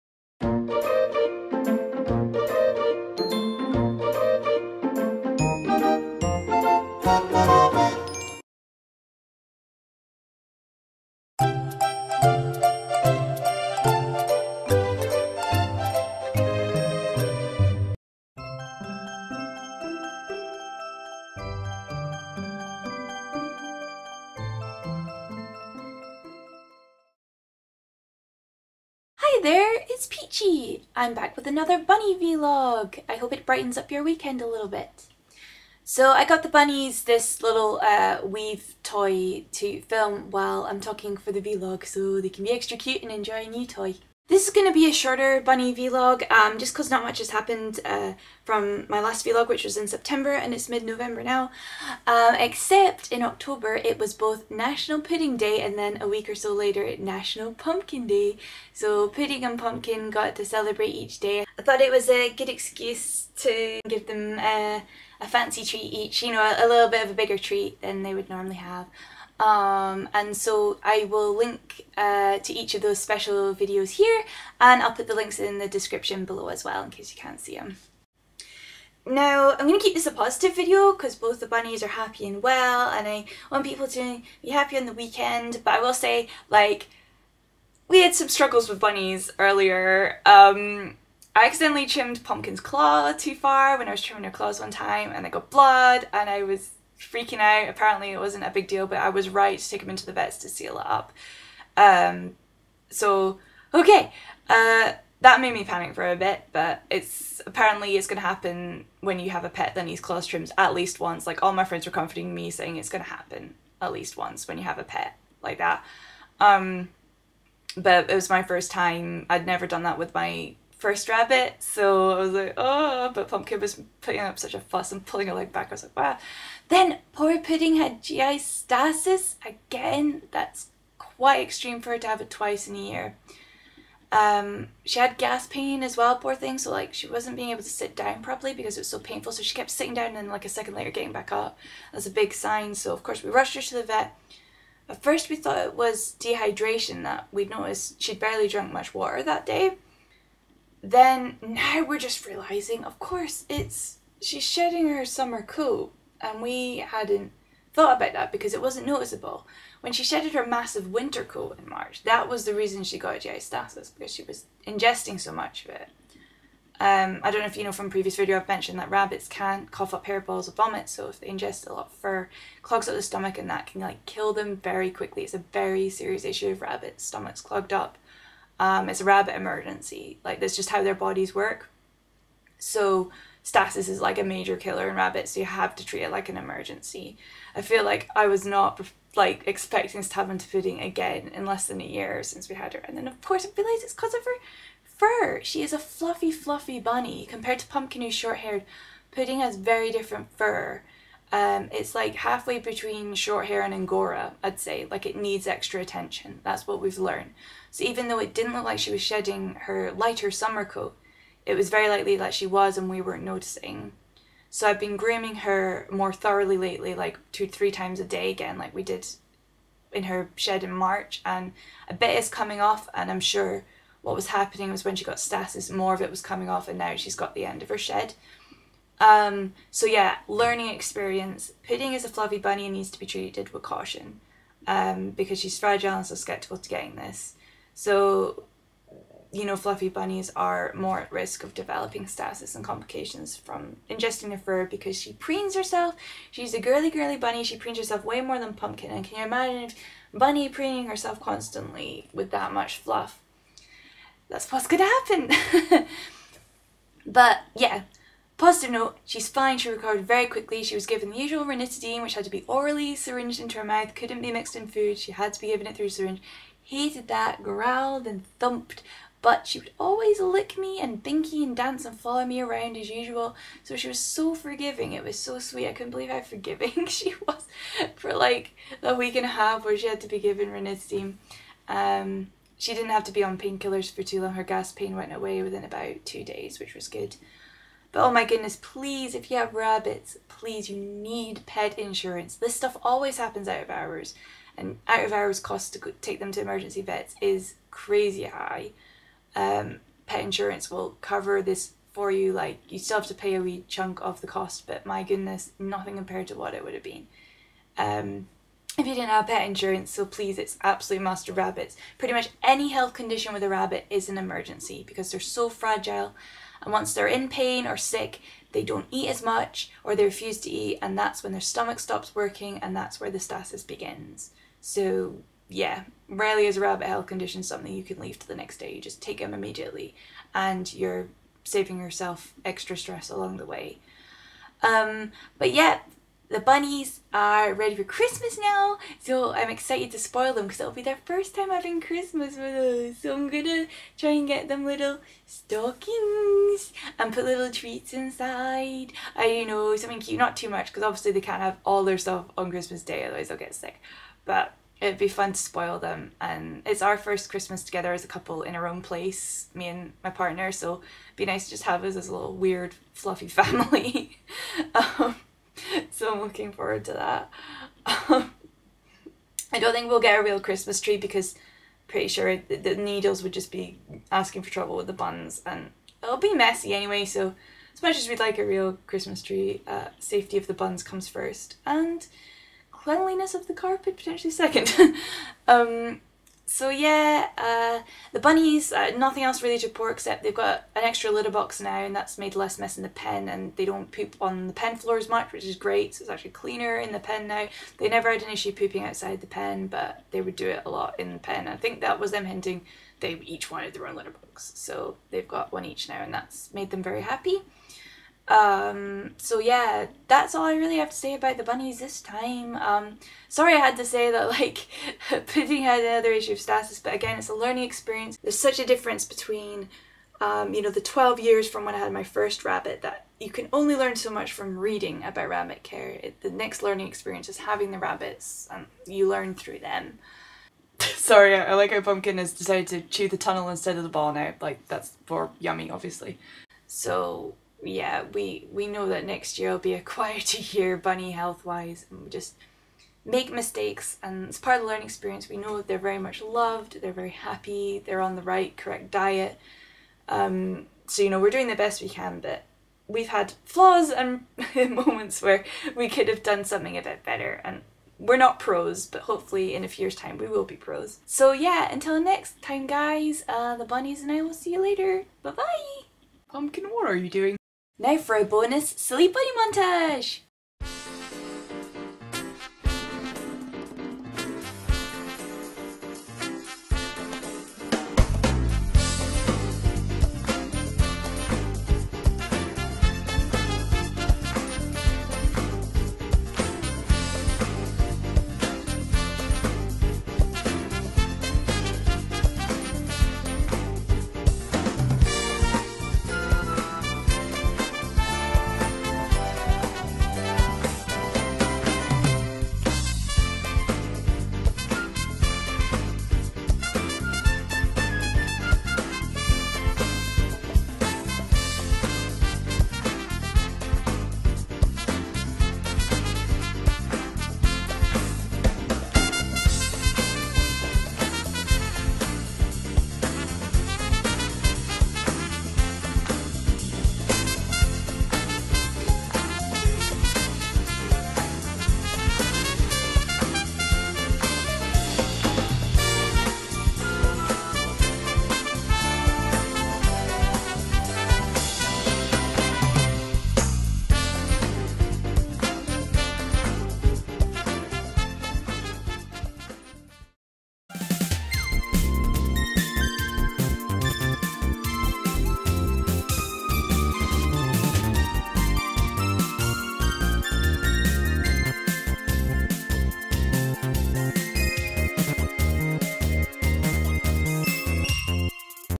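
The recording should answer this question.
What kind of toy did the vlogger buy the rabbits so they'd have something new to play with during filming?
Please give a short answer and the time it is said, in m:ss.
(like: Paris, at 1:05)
weave toy, at 0:38.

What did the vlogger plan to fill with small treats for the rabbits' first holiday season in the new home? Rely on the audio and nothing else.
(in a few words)
little stockings.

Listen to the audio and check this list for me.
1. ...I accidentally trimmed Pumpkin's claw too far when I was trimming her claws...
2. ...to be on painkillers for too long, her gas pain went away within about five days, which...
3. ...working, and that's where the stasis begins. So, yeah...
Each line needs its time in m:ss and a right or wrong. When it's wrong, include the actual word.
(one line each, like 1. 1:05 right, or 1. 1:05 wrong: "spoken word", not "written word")
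1. 1:31 right
2. 4:43 wrong: "two", not "five"
3. 5:22 right.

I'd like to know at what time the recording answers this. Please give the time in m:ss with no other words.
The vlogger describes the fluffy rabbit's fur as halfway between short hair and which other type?
3:23.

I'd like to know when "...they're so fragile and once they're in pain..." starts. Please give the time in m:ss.
5:15.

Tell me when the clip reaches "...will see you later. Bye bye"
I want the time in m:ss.
7:44.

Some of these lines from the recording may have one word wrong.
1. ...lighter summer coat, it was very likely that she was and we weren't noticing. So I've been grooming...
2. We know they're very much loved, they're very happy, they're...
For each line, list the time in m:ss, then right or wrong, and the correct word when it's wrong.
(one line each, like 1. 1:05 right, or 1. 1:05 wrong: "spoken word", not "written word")
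1. 3:29 right
2. 7:25 right.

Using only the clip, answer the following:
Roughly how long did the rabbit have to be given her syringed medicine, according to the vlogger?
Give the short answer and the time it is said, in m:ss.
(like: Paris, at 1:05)
a week and a half, at 4:38.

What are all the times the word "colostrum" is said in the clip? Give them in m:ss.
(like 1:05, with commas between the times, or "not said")
1:50.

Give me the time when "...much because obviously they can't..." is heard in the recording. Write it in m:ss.
5:50.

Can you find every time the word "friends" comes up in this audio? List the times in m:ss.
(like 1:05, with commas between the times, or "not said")
1:51.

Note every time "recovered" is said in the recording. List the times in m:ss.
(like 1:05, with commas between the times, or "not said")
4:19.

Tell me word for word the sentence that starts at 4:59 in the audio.
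Um, pet insurance will cover this for you.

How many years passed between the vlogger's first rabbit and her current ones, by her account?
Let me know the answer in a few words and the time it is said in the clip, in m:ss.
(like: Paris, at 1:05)
12, at 7:00.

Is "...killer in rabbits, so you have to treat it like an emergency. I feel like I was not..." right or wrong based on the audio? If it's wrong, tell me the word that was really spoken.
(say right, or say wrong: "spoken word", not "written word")
right.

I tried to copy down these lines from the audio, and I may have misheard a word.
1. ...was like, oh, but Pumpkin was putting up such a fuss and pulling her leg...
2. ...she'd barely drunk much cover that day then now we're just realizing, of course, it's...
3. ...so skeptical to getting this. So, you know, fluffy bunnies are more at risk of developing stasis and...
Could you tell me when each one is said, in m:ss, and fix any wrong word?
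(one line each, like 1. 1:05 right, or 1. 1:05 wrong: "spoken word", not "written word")
1. 2:02 right
2. 2:28 wrong: "water", not "cover"
3. 3:56 right.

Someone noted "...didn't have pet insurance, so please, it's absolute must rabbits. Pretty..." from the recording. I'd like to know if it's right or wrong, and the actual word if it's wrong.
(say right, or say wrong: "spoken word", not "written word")
right.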